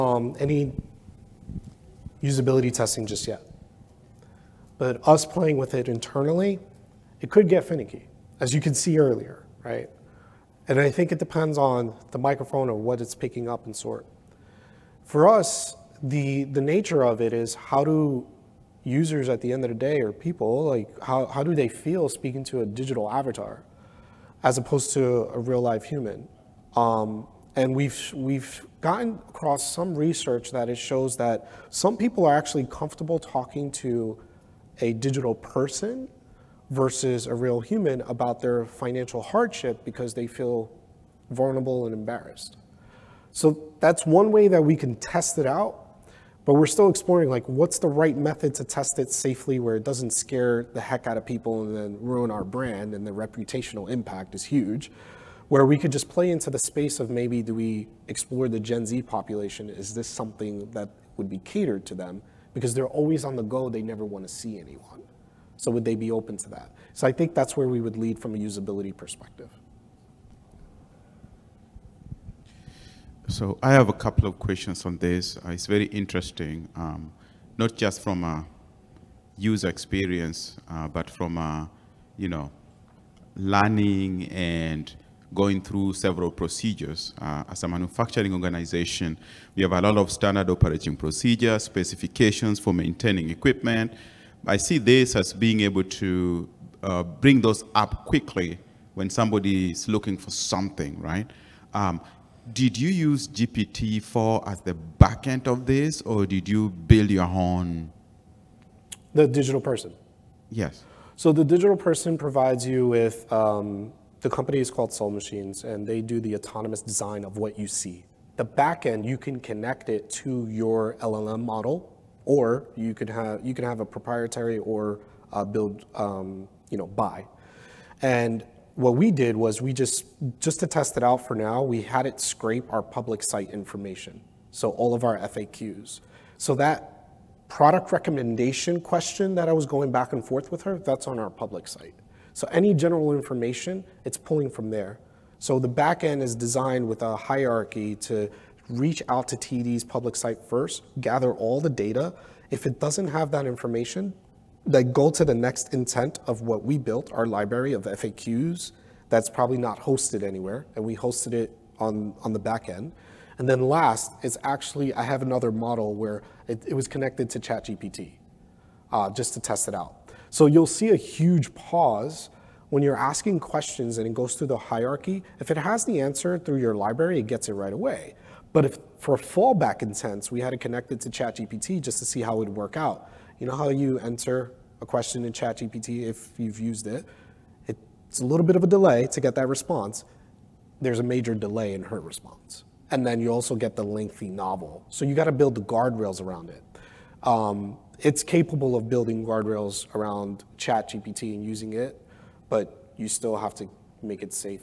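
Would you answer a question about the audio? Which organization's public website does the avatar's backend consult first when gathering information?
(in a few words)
TD.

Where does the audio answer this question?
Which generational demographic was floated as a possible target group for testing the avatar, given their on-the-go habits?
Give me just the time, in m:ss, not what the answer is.
0:58.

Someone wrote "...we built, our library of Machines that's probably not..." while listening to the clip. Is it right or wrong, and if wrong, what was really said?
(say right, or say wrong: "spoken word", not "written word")
wrong: "FAQs", not "Machines".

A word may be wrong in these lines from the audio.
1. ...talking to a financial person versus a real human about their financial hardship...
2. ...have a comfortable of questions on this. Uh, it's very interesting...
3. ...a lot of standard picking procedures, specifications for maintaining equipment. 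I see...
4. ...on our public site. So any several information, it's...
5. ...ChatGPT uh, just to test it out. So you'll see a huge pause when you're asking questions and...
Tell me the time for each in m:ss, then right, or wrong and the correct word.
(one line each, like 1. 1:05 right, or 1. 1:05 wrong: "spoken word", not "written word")
1. 0:33 wrong: "digital", not "financial"
2. 1:13 wrong: "couple", not "comfortable"
3. 1:29 wrong: "operating", not "picking"
4. 2:21 wrong: "general", not "several"
5. 2:47 right.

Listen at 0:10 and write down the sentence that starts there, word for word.
And I think it depends on the microphone or what it's picking up and sort.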